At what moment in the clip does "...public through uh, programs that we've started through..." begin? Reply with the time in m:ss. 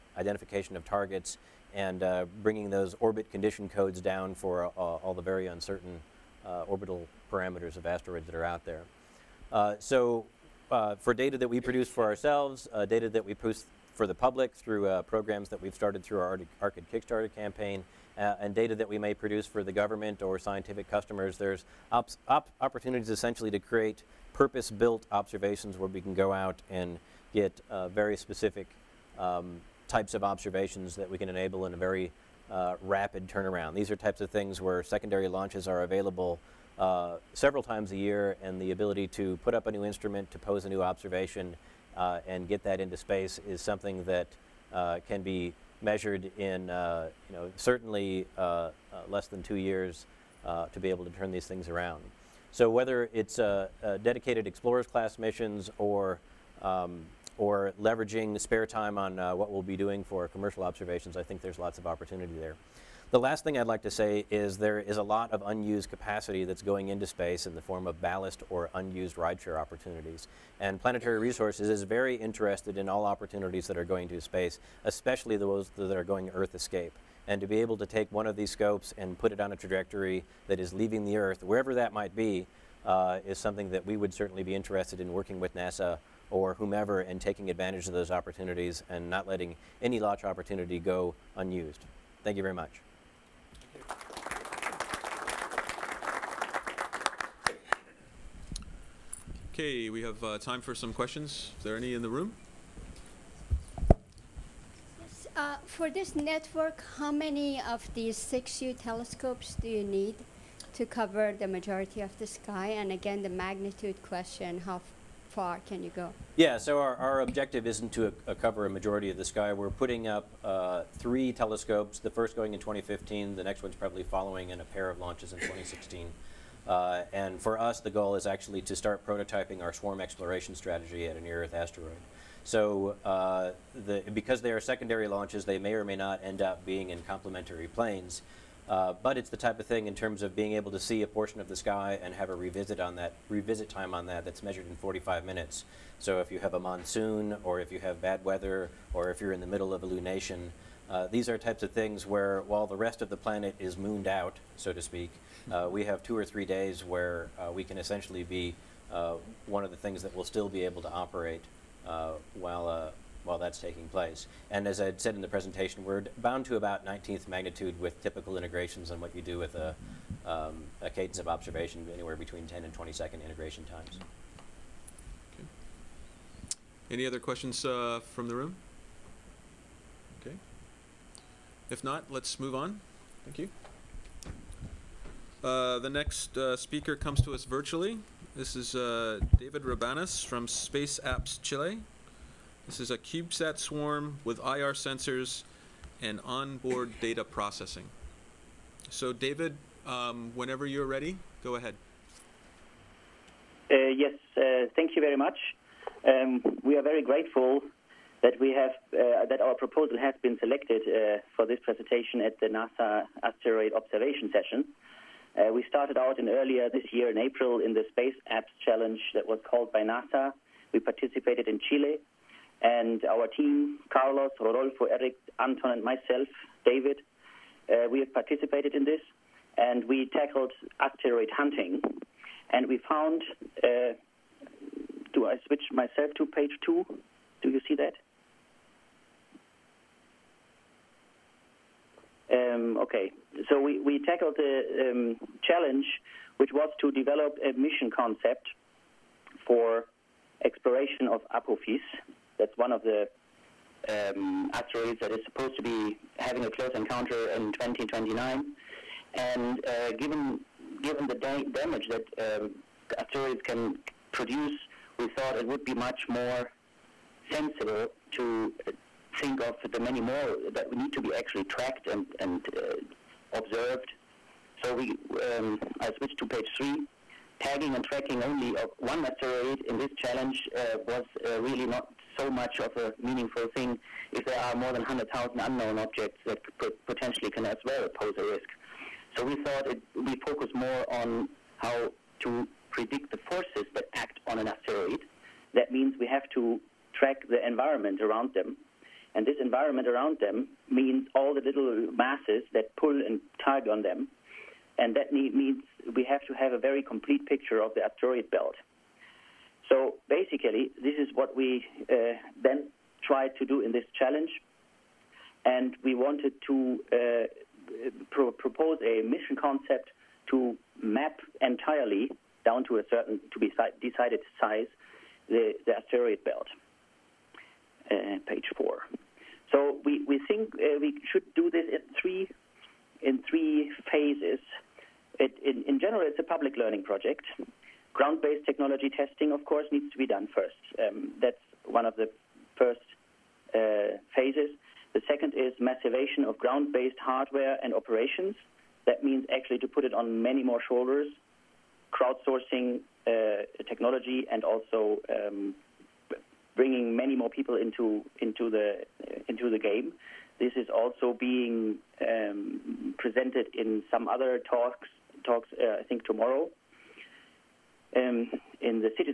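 0:14.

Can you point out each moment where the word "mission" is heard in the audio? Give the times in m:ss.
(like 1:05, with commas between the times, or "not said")
0:55, 4:07, 5:19.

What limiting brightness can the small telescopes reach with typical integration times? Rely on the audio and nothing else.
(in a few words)
19th magnitude.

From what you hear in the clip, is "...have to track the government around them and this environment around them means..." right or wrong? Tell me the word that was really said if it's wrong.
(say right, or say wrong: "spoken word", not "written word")
wrong: "environment", not "government".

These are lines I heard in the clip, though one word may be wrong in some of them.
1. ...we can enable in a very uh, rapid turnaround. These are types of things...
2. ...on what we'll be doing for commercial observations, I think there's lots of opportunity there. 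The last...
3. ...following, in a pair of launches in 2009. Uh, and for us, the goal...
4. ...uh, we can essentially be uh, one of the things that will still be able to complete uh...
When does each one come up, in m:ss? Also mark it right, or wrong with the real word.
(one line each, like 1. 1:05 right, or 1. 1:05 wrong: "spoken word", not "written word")
1. 0:31 right
2. 0:58 right
3. 2:04 wrong: "2016", not "2009"
4. 2:37 wrong: "operate", not "complete".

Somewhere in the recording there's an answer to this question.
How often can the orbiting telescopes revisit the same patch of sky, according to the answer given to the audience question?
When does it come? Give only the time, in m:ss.
2:24.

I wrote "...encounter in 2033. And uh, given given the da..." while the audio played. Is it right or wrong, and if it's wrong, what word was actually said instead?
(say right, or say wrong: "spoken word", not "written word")
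wrong: "2029", not "2033".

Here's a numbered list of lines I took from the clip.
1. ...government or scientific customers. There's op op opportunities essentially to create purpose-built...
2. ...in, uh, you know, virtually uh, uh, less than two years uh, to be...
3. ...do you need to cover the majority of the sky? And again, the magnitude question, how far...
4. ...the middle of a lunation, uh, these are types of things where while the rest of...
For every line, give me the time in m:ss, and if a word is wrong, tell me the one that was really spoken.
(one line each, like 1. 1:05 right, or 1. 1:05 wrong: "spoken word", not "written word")
1. 0:19 right
2. 0:46 wrong: "certainly", not "virtually"
3. 1:49 right
4. 2:29 right.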